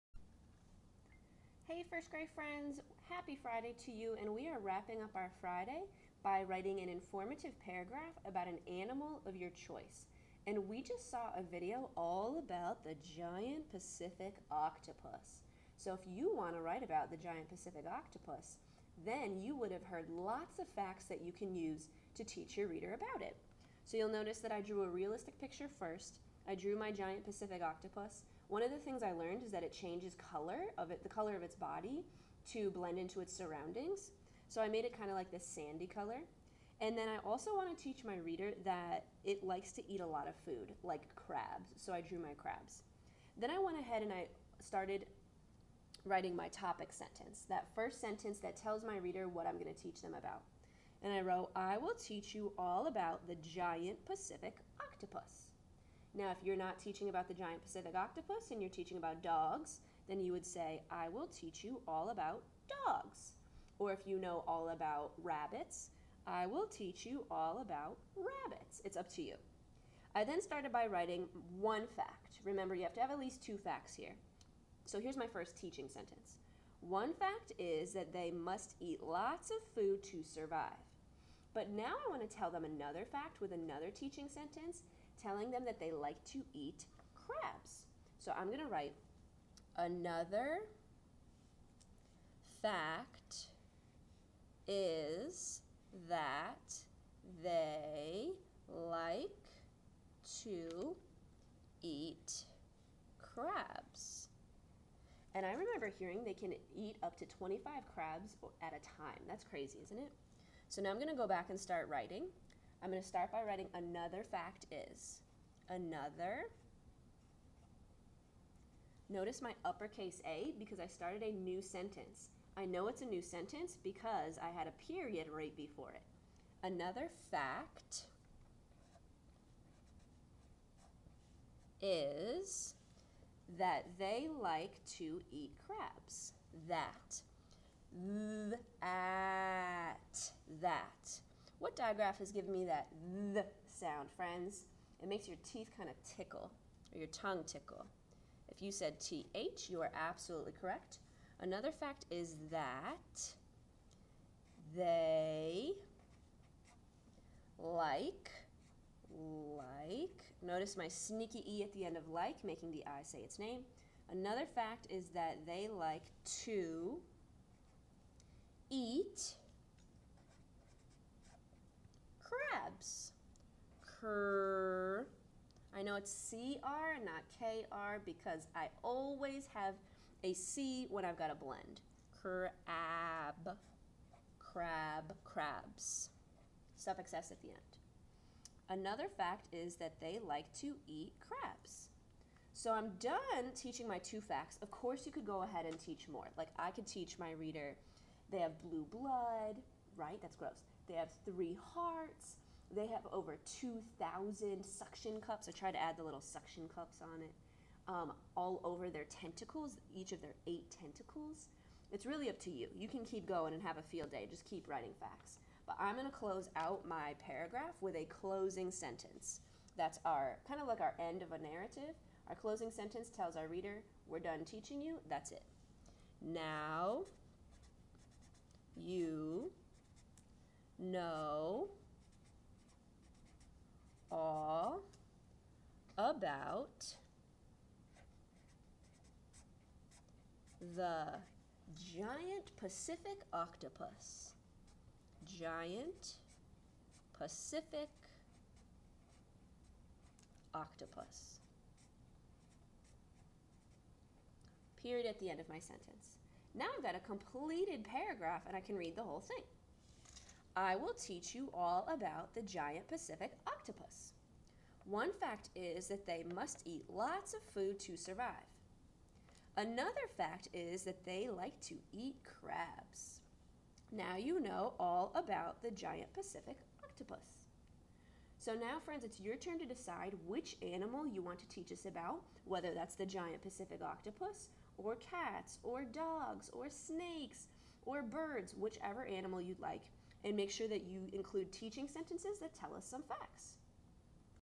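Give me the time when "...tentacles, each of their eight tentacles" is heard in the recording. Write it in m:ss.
3:29.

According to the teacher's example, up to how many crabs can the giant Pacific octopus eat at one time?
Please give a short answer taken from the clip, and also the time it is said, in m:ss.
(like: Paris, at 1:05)
25, at 1:47.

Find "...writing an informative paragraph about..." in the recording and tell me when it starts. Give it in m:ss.
0:06.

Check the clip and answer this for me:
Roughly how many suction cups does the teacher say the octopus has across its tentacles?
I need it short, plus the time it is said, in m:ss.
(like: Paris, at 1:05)
Over 2,000, at 3:23.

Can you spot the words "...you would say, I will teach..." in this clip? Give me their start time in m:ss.
1:00.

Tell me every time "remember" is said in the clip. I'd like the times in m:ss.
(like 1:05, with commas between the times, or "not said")
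1:12, 1:45.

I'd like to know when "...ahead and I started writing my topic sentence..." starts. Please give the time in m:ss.
0:43.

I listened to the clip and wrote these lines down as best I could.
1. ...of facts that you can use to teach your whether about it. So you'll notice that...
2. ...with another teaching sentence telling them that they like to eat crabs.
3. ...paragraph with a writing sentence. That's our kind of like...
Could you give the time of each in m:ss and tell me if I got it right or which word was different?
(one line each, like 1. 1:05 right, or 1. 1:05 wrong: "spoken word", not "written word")
1. 0:20 wrong: "reader", not "whether"
2. 1:23 right
3. 3:37 wrong: "closing", not "writing".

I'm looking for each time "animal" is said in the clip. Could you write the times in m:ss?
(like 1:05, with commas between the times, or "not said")
0:08, 4:40, 4:49.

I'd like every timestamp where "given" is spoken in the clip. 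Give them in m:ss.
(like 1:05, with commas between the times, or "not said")
2:22.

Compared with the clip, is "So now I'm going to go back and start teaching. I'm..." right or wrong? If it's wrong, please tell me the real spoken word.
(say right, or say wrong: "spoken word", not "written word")
wrong: "writing", not "teaching".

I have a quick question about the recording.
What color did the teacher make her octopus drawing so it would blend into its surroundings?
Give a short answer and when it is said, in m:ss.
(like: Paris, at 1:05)
Sandy, at 0:35.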